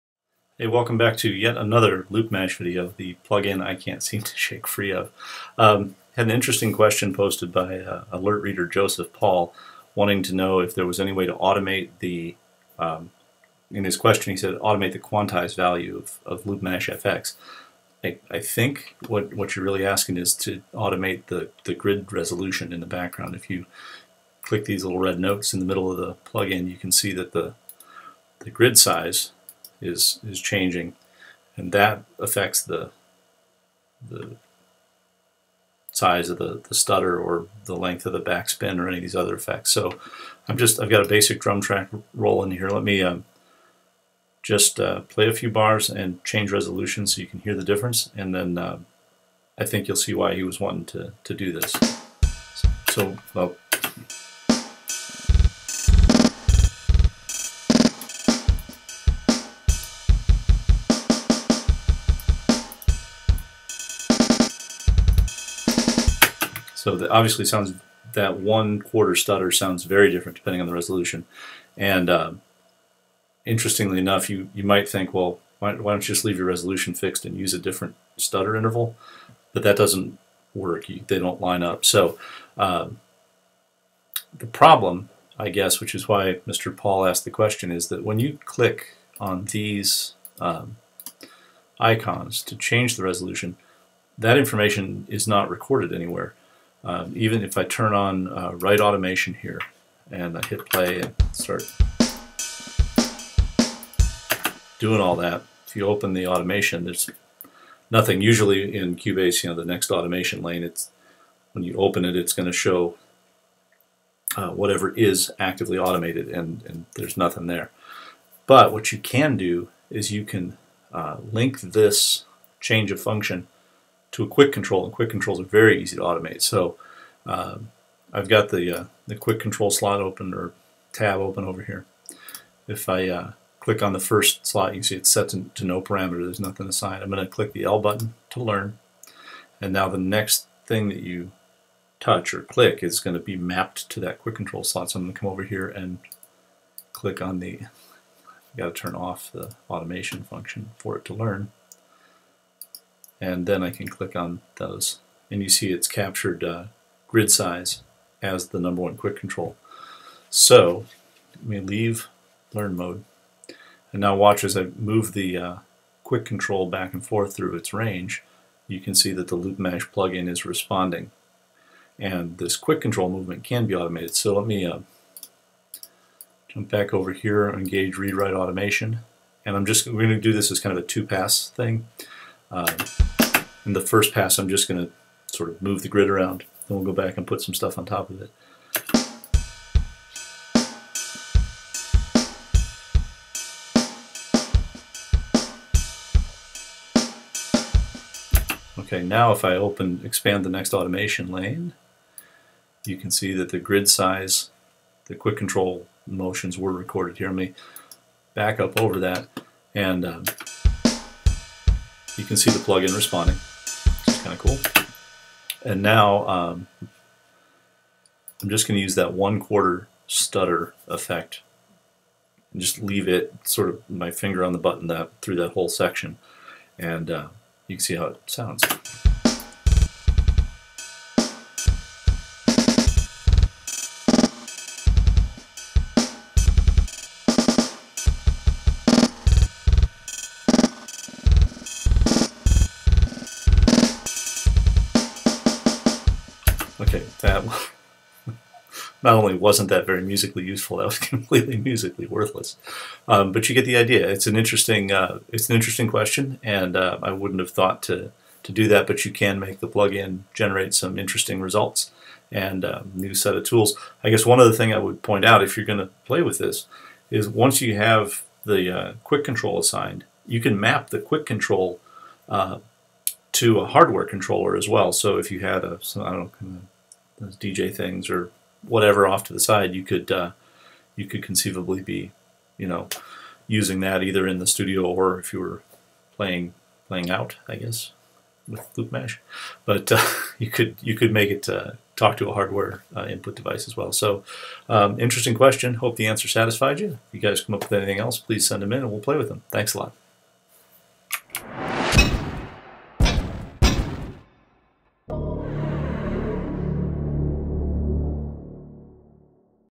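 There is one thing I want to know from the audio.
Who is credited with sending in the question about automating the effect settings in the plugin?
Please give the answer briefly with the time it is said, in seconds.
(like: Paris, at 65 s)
Joseph Paul, at 8 s.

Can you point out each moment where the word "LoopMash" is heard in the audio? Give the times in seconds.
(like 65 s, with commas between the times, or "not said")
2 s, 16 s, 169 s, 288 s.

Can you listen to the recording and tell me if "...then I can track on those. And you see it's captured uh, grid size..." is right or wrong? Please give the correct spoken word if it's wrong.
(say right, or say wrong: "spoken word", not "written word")
wrong: "click", not "track".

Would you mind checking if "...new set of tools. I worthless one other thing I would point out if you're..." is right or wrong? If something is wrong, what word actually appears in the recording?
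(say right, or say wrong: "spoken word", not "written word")
wrong: "guess", not "worthless".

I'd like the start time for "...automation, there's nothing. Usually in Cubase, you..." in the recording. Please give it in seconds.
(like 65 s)
106 s.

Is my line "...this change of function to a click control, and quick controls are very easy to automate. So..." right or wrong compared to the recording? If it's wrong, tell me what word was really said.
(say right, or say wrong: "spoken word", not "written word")
wrong: "quick", not "click".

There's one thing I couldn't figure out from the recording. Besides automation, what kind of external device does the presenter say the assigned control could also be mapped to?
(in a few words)
Hardware controller.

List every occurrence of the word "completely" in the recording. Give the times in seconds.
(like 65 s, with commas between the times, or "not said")
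250 s.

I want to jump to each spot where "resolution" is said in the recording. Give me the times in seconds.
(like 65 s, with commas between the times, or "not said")
22 s, 46 s, 70 s, 76 s, 93 s.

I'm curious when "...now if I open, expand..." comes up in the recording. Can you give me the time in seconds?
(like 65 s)
199 s.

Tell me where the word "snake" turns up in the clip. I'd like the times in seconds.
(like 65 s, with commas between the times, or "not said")
not said.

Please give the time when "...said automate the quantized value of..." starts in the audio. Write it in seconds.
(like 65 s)
14 s.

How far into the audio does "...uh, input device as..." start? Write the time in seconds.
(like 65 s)
292 s.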